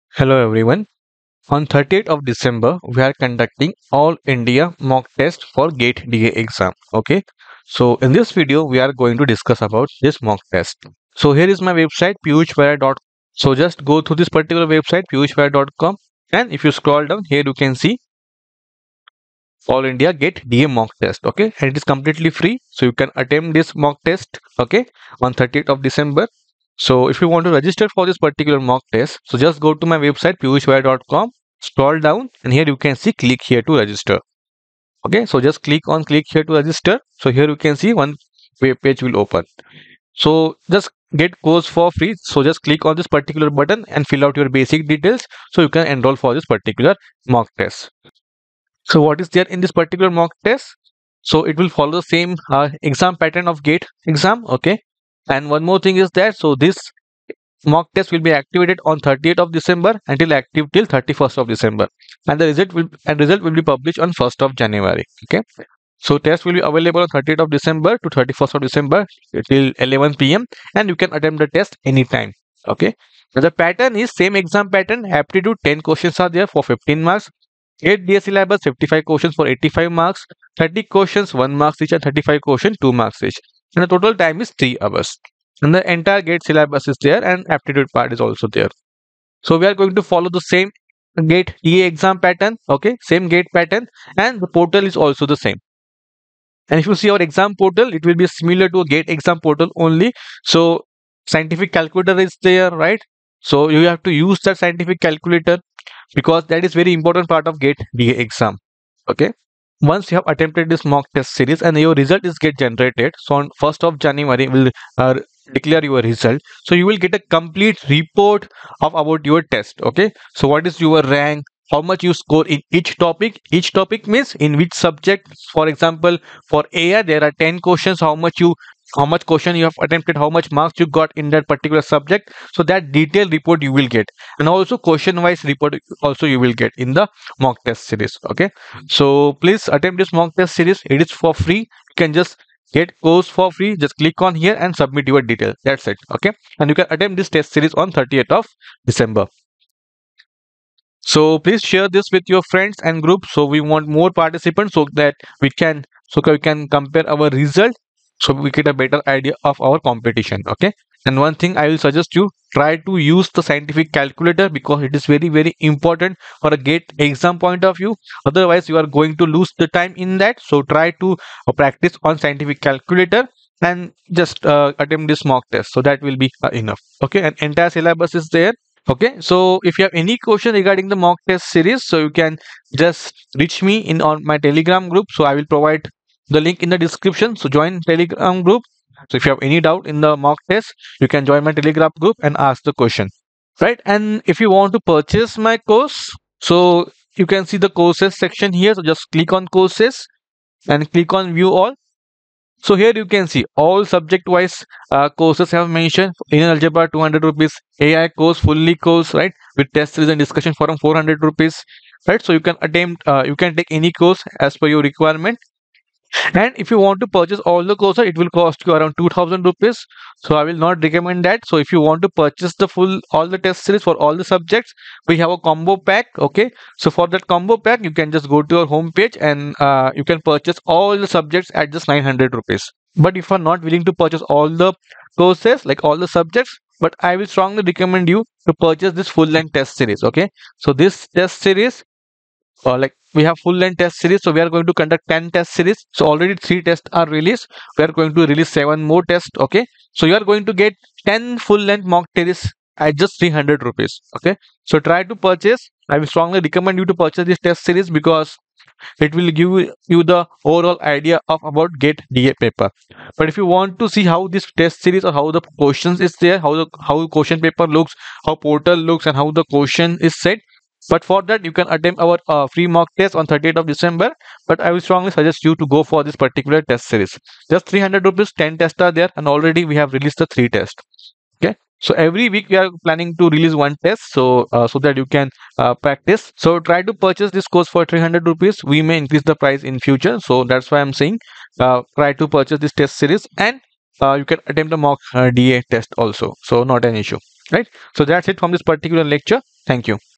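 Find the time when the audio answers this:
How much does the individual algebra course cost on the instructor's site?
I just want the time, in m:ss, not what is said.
3:26.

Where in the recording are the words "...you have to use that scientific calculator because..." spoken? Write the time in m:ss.
1:43.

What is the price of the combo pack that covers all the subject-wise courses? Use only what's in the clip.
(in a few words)
900 rupees.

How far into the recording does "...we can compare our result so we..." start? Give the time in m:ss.
2:36.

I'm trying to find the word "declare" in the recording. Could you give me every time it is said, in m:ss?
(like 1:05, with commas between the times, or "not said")
1:55.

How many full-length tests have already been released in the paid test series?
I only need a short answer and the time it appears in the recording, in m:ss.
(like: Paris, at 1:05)
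3, at 4:06.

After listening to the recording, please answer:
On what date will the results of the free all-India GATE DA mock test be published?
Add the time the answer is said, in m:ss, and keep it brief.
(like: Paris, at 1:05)
1st of January, at 1:03.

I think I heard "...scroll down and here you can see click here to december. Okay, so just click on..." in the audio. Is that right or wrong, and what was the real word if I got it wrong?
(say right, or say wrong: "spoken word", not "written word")
wrong: "register", not "december".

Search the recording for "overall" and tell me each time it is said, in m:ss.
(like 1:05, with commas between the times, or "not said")
4:20.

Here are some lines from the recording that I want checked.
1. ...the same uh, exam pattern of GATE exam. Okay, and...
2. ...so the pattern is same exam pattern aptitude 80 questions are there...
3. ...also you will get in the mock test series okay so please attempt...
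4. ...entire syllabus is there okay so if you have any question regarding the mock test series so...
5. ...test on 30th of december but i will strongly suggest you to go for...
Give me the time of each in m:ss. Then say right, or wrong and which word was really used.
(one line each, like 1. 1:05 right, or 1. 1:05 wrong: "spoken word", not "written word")
1. 0:51 right
2. 1:13 wrong: "10", not "80"
3. 2:16 right
4. 2:57 right
5. 4:33 right.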